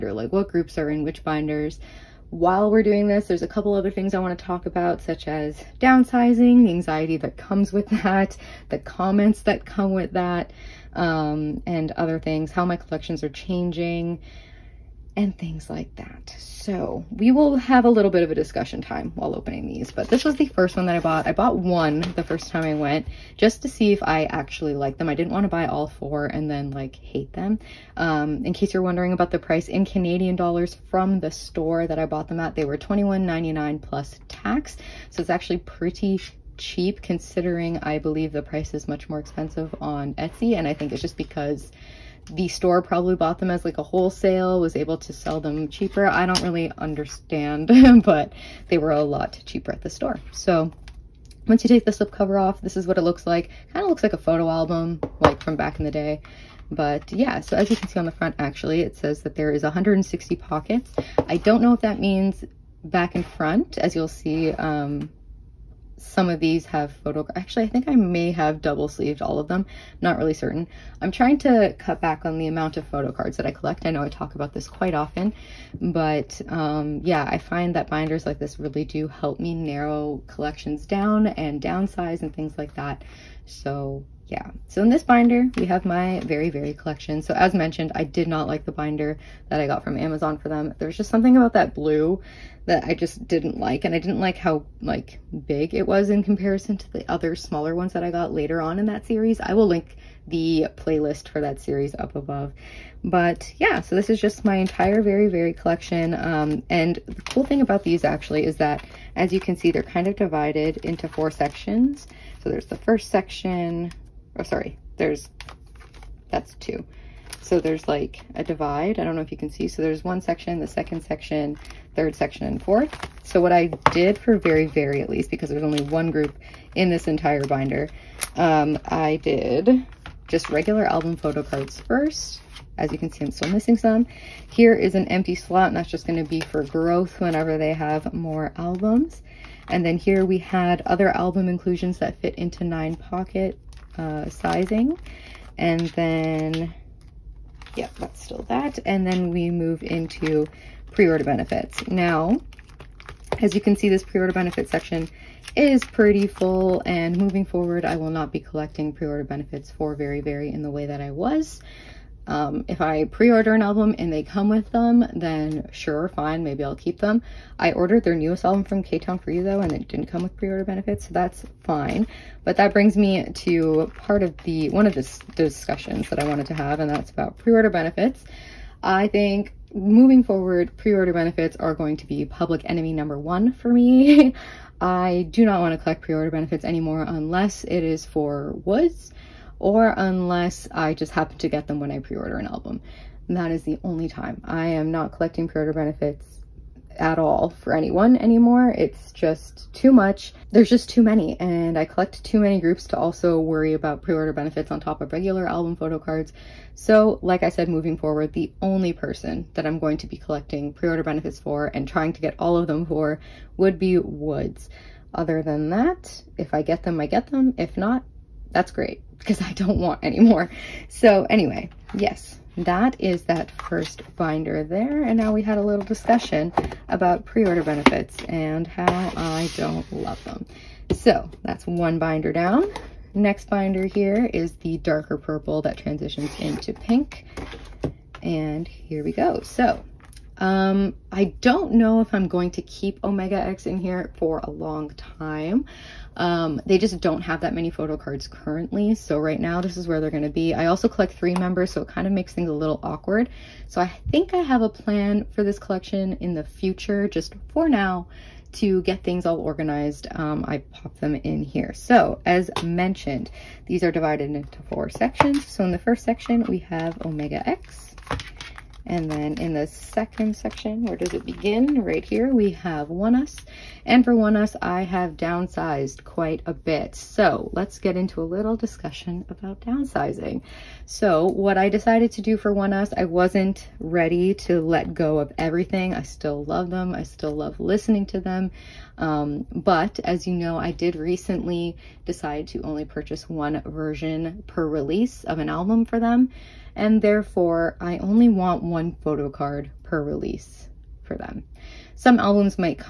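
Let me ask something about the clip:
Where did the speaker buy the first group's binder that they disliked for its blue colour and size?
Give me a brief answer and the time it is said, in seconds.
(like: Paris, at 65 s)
Amazon, at 89 s.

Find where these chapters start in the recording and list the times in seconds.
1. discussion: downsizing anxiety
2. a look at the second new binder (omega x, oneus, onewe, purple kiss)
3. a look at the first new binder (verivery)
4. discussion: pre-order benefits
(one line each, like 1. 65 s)
1. 277 s
2. 233 s
3. 20 s
4. 172 s.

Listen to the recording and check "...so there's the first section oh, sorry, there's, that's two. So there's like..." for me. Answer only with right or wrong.
right.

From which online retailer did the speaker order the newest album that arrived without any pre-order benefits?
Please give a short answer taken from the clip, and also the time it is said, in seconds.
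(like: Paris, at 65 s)
Ktown4u, at 168 s.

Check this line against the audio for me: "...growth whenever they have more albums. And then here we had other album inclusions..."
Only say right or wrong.
right.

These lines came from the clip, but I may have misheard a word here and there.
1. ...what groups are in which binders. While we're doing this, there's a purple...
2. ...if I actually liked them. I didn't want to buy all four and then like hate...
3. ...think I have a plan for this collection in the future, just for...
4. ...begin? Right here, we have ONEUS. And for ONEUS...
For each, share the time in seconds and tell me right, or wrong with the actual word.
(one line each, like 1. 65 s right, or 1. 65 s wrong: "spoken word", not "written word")
1. 0 s wrong: "couple", not "purple"
2. 23 s right
3. 254 s right
4. 271 s right.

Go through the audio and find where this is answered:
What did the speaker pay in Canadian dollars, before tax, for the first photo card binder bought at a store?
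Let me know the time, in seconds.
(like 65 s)
32 s.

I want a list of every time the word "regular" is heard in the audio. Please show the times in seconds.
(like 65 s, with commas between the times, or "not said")
130 s, 205 s.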